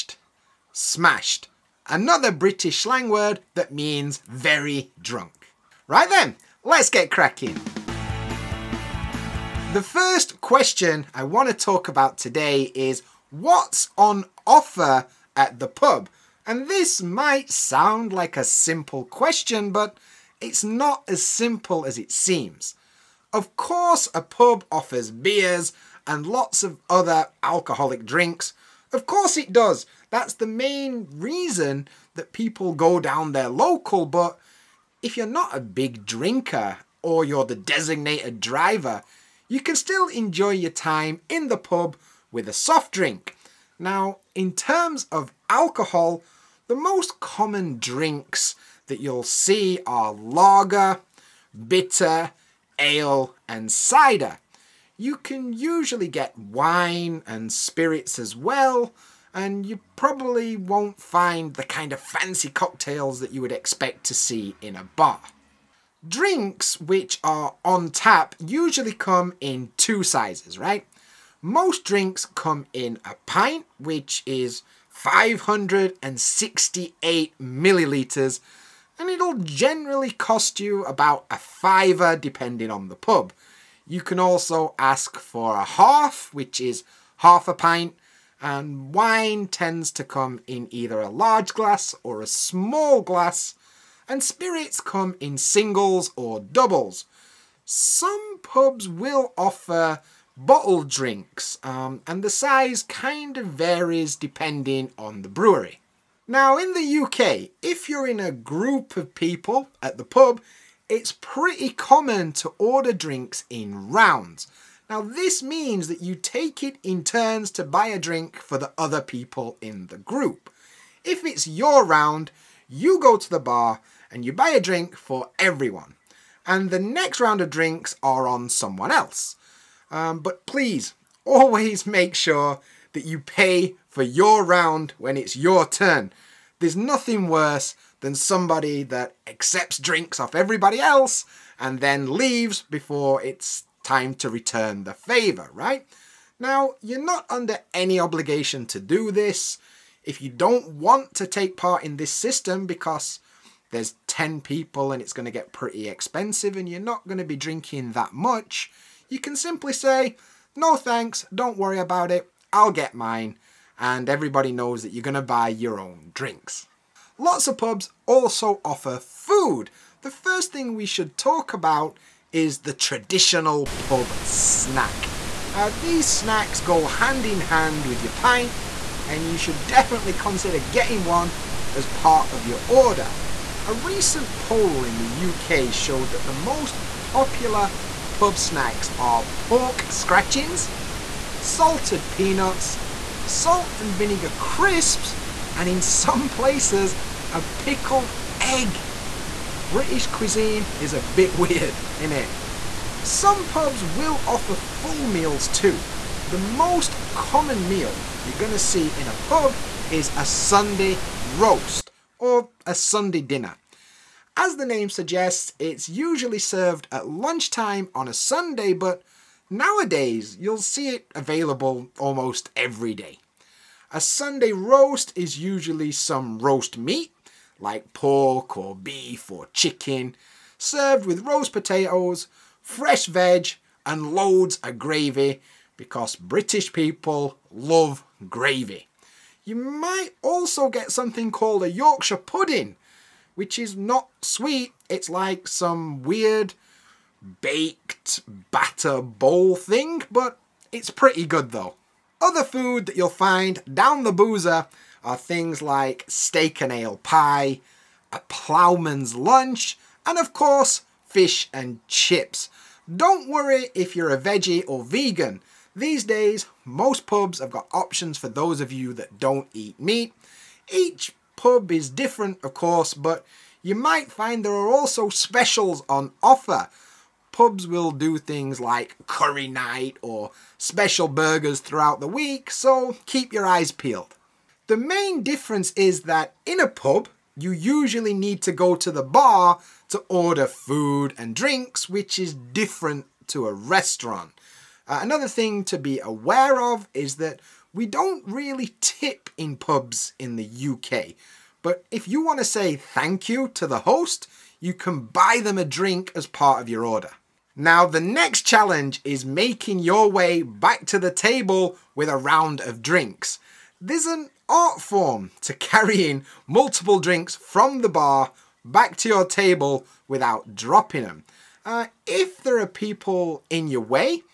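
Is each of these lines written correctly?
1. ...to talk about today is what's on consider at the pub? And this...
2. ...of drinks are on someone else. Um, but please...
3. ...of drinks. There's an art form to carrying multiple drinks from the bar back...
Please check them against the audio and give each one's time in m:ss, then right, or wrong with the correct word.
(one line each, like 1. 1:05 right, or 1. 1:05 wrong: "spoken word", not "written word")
1. 0:11 wrong: "offer", not "consider"
2. 2:07 right
3. 5:12 right.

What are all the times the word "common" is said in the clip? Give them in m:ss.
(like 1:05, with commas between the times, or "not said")
0:47, 1:51, 3:27.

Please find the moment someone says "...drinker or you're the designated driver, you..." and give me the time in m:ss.
0:36.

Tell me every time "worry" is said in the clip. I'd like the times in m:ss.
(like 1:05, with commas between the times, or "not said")
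2:41, 4:23.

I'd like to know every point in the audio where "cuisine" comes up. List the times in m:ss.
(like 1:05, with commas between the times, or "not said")
3:20.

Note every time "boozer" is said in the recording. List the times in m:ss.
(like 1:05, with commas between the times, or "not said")
4:14.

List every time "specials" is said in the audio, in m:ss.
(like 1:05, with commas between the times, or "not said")
4:35, 4:40.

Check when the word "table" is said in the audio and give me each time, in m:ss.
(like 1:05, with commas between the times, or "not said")
5:11, 5:19.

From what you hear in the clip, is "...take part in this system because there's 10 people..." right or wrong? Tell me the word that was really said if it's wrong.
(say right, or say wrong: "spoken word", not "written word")
right.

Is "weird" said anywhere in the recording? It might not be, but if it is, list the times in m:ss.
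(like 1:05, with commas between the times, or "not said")
3:21, 4:06.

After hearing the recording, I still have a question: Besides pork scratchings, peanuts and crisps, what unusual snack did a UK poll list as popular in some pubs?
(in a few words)
a pickled egg.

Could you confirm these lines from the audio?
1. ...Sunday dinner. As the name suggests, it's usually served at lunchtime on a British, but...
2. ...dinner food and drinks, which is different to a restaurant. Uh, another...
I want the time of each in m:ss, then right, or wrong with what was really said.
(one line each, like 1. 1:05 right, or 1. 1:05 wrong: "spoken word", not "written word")
1. 3:32 wrong: "Sunday", not "British"
2. 4:50 wrong: "order", not "dinner".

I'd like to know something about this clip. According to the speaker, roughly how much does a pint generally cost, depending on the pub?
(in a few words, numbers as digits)
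a fiver.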